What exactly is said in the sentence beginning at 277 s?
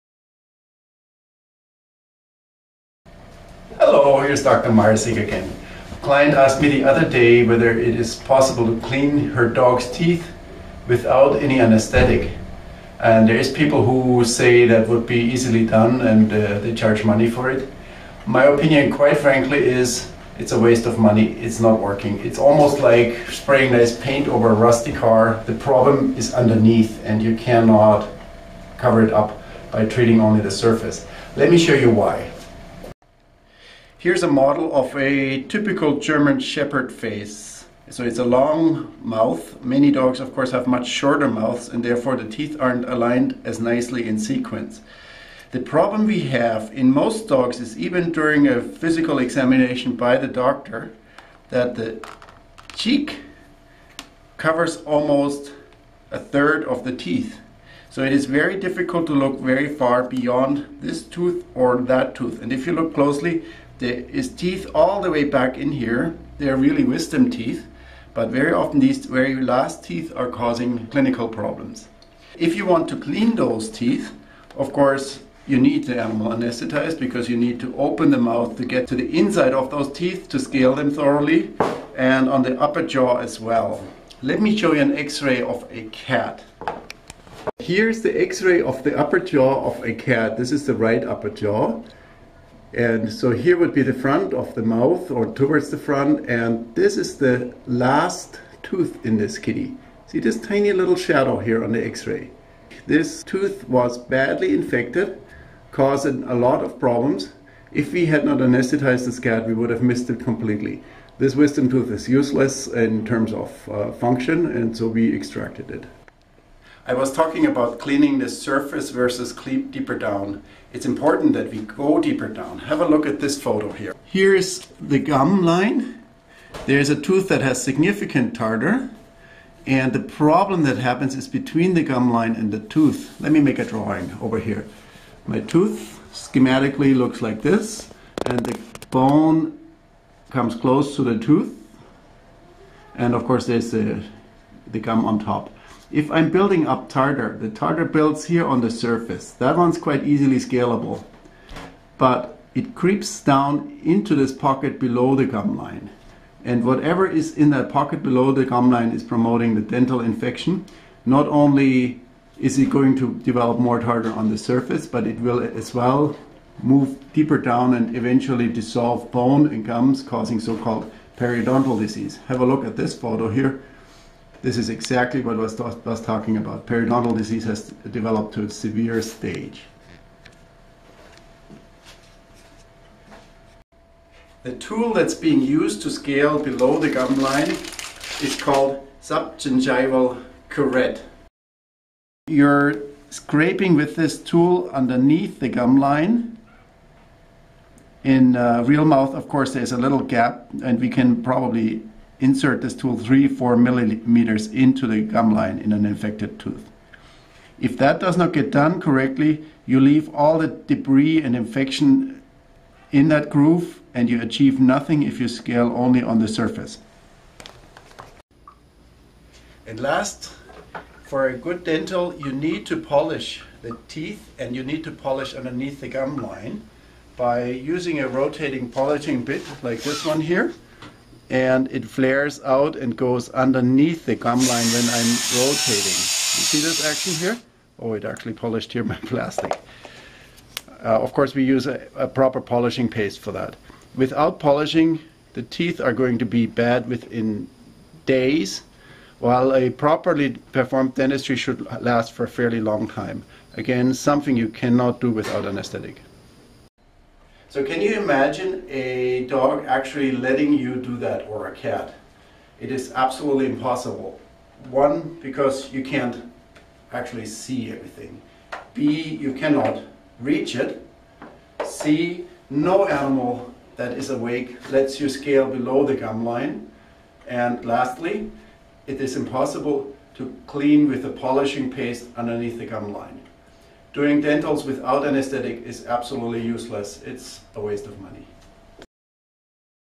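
And lastly, it is impossible to clean with a polishing paste underneath the gum line.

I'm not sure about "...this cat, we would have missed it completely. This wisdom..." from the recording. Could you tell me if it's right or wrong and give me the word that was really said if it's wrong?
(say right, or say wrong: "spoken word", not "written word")
right.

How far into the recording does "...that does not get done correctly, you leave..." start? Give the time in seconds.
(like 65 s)
207 s.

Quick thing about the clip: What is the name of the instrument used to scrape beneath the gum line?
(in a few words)
subgingival curette.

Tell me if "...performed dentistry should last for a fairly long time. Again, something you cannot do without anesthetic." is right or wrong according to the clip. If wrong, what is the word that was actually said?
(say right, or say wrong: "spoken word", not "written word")
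right.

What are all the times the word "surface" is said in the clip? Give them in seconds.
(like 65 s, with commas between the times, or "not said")
30 s, 118 s, 148 s, 164 s, 216 s.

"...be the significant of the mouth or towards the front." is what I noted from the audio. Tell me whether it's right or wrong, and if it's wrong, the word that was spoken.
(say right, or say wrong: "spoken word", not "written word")
wrong: "front", not "significant".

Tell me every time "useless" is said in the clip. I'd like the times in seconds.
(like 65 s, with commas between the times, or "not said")
112 s, 286 s.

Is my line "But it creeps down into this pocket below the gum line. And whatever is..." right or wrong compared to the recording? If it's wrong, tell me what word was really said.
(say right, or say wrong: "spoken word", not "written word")
right.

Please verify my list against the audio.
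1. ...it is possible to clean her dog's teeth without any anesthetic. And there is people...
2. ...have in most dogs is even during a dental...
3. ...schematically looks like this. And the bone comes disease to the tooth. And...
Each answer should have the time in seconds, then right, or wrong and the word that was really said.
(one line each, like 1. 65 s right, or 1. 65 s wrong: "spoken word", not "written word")
1. 7 s right
2. 46 s wrong: "physical", not "dental"
3. 136 s wrong: "close", not "disease".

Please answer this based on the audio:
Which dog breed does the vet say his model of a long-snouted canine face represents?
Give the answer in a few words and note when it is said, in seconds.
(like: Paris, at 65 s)
German Shepherd, at 35 s.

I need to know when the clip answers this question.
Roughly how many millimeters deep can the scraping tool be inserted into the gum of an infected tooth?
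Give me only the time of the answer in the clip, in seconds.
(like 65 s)
202 s.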